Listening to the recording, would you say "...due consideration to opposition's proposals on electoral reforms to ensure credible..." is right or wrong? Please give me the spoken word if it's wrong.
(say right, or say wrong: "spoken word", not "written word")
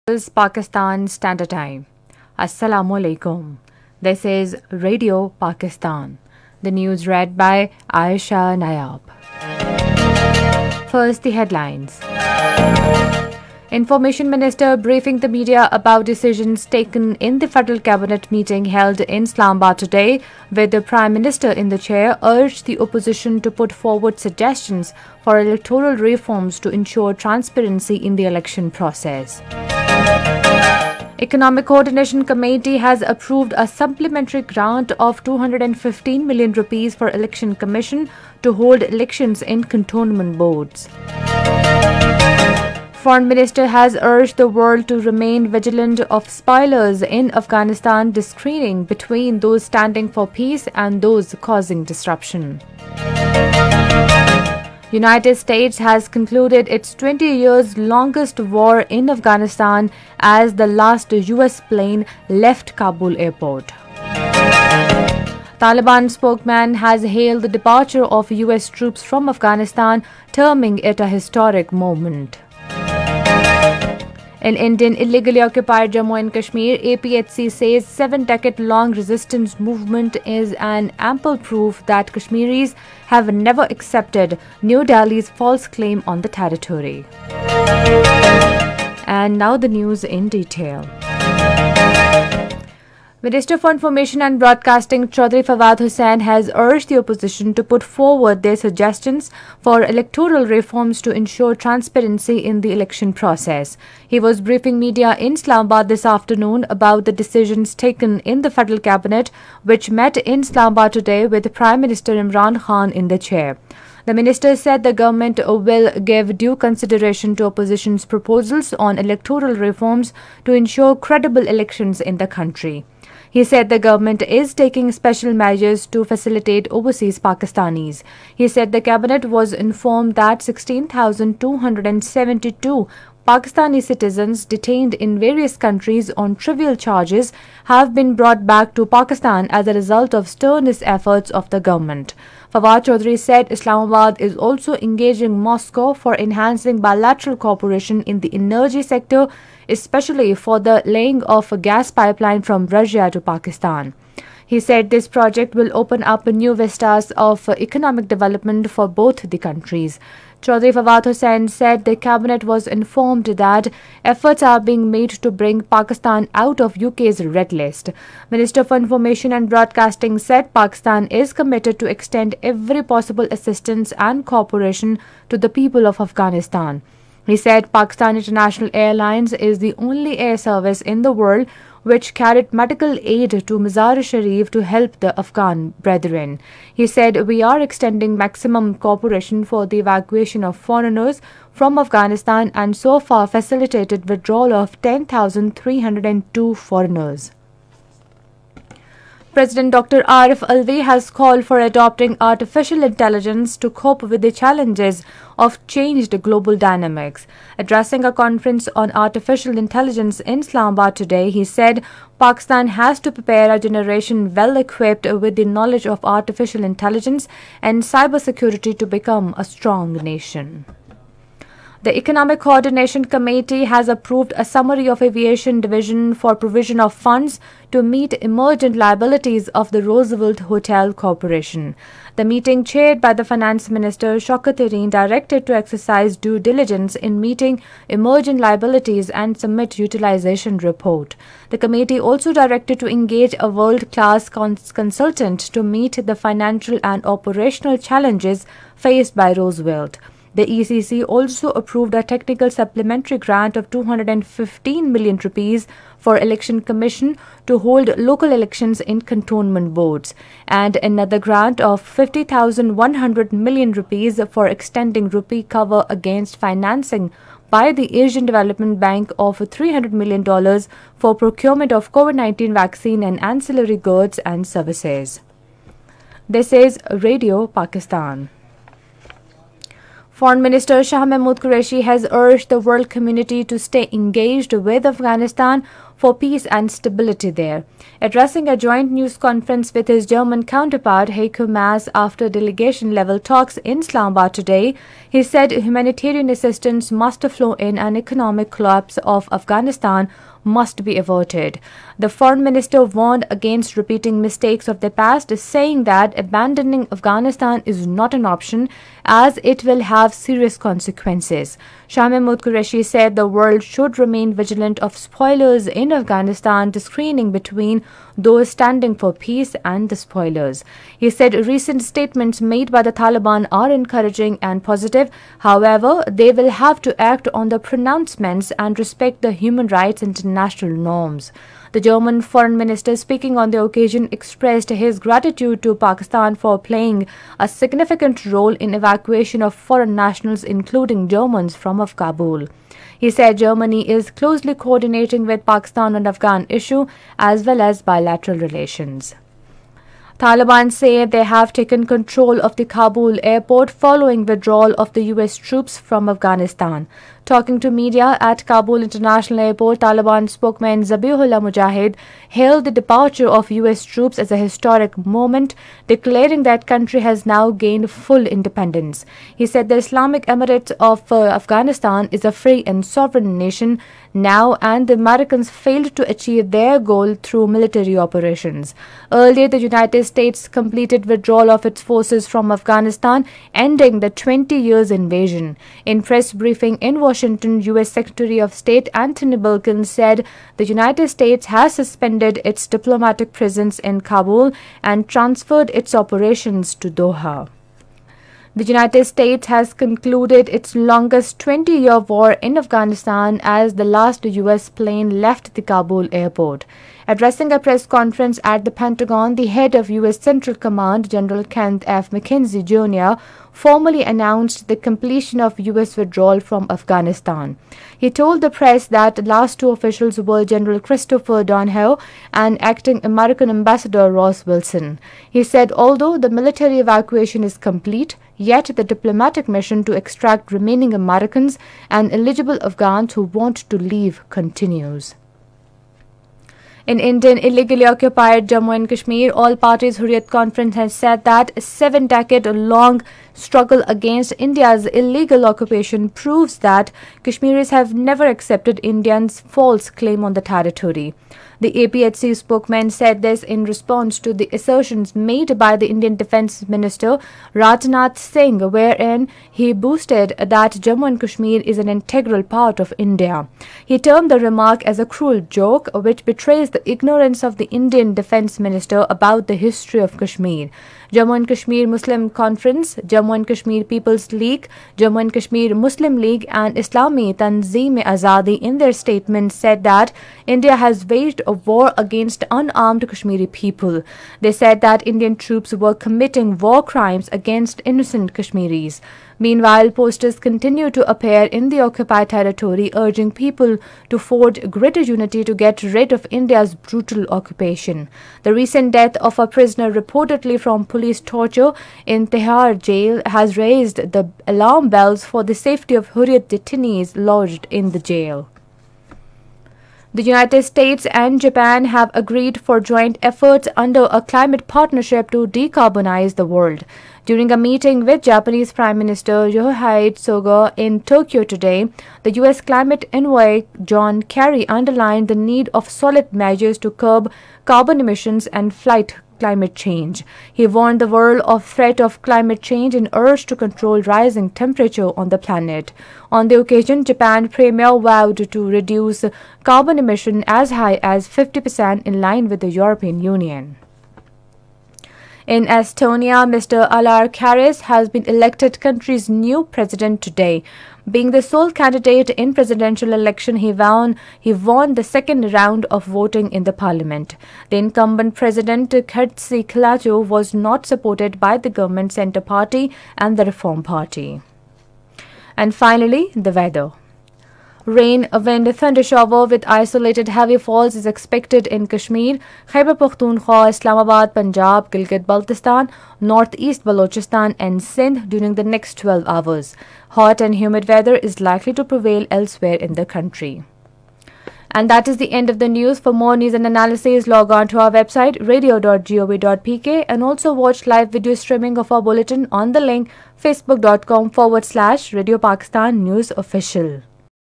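right.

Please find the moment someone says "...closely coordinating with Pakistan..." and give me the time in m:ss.
5:44.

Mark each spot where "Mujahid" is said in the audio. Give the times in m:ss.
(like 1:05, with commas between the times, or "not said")
6:01.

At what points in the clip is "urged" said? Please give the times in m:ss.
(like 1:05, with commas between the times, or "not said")
0:22, 0:44, 1:36, 4:42, 8:53.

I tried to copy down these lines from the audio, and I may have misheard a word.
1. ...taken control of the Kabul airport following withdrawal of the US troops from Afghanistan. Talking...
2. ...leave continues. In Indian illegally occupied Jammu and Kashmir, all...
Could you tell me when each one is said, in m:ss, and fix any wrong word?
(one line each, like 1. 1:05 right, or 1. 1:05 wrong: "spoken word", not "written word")
1. 5:51 right
2. 7:13 right.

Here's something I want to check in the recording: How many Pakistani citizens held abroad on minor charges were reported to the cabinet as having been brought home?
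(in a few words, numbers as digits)
16,272.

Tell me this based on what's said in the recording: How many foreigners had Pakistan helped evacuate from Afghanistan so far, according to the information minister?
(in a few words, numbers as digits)
10,302.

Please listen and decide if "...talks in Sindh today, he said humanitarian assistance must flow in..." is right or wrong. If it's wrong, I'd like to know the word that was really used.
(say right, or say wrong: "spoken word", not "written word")
wrong: "Islamabad", not "Sindh".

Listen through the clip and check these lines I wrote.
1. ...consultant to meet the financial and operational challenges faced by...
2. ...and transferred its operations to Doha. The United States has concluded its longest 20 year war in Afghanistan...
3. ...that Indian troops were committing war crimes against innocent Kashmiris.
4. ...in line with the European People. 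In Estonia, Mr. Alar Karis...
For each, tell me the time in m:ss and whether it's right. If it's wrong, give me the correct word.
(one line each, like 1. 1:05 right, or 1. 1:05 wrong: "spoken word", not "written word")
1. 4:04 right
2. 6:34 right
3. 8:04 right
4. 9:02 wrong: "Union", not "People".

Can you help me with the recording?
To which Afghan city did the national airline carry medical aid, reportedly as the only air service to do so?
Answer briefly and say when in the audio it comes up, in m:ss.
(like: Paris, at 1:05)
Mazar Sharif, at 3:03.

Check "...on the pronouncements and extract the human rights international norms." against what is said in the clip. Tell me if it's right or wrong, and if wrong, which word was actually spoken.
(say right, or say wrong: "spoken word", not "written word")
wrong: "respect", not "extract".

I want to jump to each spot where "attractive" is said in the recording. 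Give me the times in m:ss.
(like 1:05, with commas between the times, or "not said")
not said.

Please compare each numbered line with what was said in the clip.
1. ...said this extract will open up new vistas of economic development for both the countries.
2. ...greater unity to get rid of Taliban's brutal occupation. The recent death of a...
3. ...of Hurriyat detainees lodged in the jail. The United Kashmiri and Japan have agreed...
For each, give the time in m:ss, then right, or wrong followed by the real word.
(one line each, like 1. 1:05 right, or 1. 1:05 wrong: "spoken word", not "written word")
1. 2:34 wrong: "project", not "extract"
2. 8:14 wrong: "India", not "Taliban"
3. 8:25 wrong: "States", not "Kashmiri".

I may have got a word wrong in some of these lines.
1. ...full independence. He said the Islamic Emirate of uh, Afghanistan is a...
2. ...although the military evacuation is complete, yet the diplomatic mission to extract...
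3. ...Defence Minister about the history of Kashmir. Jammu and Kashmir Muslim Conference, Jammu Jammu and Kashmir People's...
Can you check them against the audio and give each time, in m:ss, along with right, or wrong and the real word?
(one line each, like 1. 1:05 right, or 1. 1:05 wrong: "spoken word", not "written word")
1. 6:07 right
2. 7:05 right
3. 7:48 right.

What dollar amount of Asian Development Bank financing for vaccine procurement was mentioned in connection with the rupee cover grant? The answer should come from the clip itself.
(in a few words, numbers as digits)
$300 million.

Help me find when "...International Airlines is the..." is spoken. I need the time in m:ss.
2:58.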